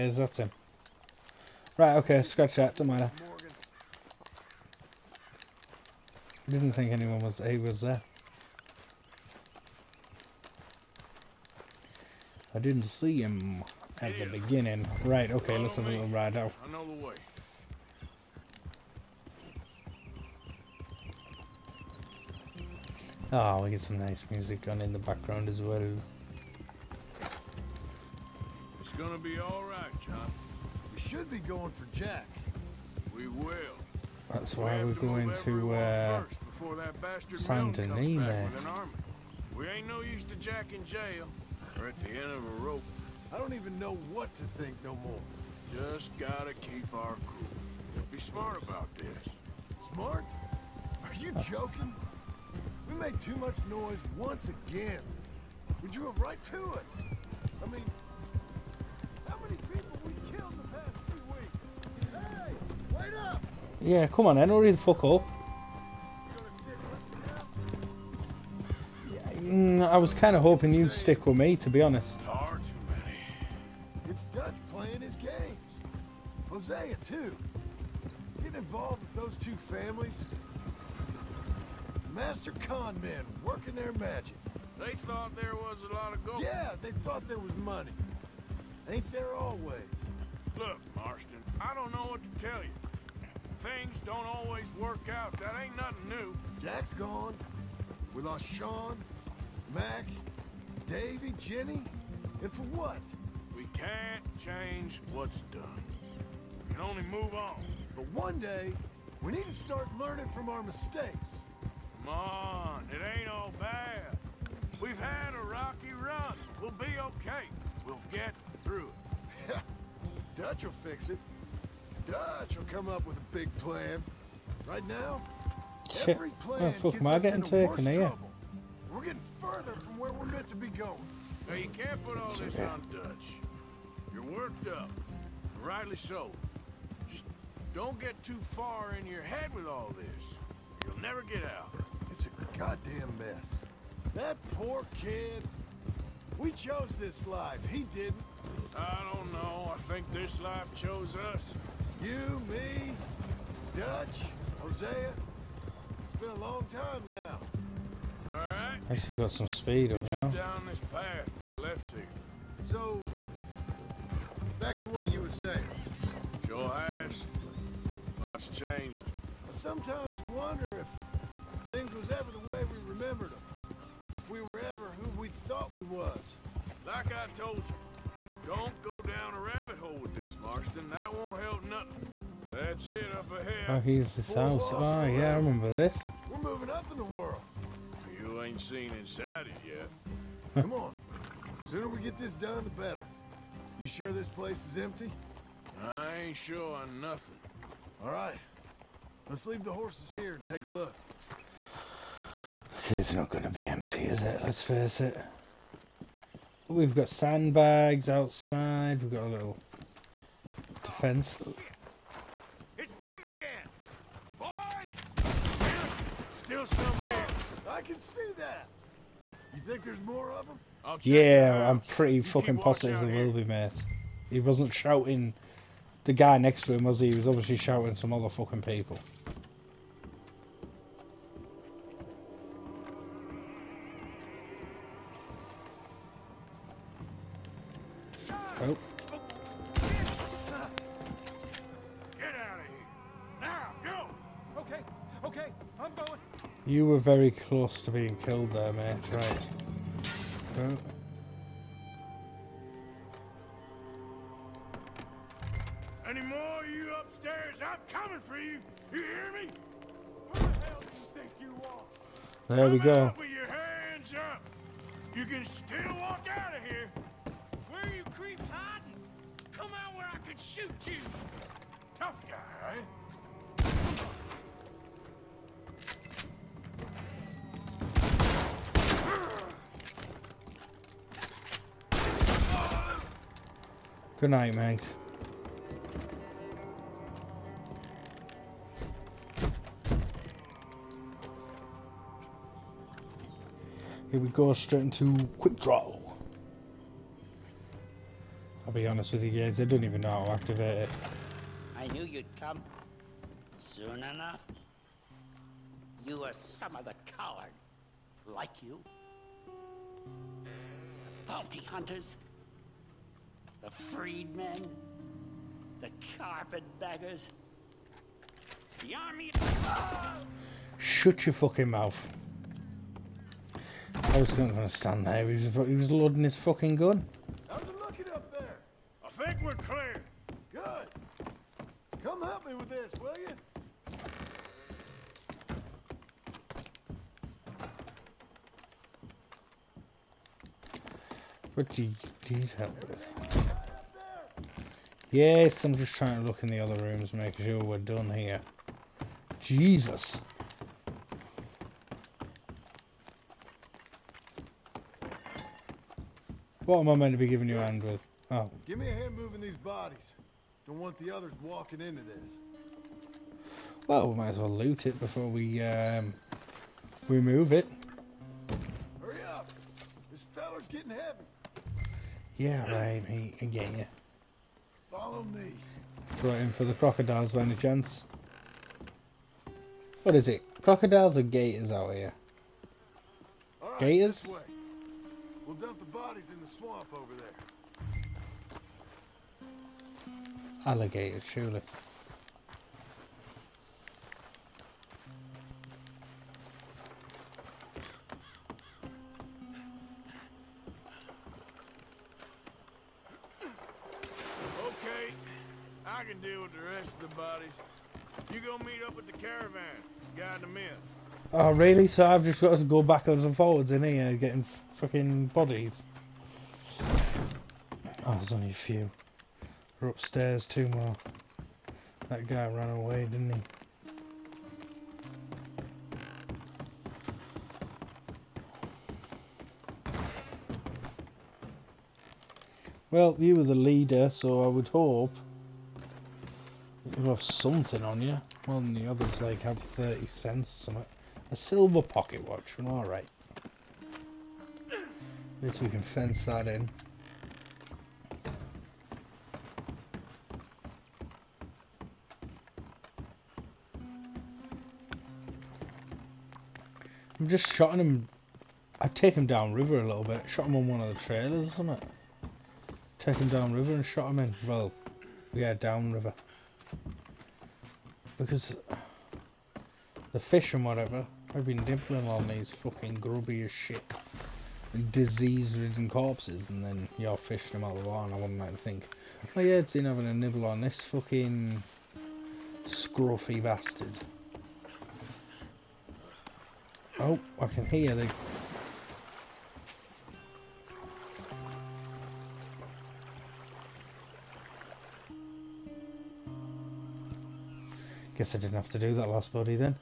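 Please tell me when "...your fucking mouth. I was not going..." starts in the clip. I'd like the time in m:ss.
5:21.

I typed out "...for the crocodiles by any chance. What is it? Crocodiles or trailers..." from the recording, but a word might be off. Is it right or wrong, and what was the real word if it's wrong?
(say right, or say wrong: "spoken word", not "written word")
wrong: "gators", not "trailers".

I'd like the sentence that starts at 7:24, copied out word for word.
At least we can fence that in.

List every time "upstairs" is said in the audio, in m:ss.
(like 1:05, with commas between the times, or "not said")
4:17, 6:59.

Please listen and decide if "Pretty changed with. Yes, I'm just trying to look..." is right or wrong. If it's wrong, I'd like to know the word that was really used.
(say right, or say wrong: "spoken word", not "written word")
wrong: "detailed", not "changed".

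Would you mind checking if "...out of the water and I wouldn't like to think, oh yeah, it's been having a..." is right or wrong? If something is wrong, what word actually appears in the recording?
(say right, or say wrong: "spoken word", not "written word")
right.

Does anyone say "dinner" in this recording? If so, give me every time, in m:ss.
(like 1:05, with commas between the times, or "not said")
not said.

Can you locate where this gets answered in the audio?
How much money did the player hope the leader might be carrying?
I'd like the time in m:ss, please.
7:19.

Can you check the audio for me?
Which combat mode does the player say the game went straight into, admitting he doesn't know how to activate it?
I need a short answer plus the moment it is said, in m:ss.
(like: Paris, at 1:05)
quick draw, at 4:54.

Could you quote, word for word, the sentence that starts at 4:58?
I'll be honest with you guys, I don't even know how to activate it.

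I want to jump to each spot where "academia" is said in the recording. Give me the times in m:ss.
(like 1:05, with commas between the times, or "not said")
not said.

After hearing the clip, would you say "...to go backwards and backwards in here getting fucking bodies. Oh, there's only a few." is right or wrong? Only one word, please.
wrong.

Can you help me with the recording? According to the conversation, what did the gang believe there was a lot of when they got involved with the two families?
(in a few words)
gold.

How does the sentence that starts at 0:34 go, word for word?
That's why we we're going to uh, San We ain't no use to Jack in jail.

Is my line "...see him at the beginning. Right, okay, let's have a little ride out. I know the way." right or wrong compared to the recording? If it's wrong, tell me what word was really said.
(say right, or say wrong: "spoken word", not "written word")
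right.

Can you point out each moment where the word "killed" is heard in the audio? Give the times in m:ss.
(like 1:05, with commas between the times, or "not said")
1:00, 4:08.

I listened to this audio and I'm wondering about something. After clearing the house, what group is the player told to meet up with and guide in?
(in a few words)
the caravan.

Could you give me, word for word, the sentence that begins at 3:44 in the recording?
He wasn't shouting the guy next to him, was he?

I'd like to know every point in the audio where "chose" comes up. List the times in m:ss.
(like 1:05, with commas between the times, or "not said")
2:26, 2:30.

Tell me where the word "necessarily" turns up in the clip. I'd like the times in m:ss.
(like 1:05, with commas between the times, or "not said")
not said.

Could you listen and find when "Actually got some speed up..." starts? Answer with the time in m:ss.
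2:38.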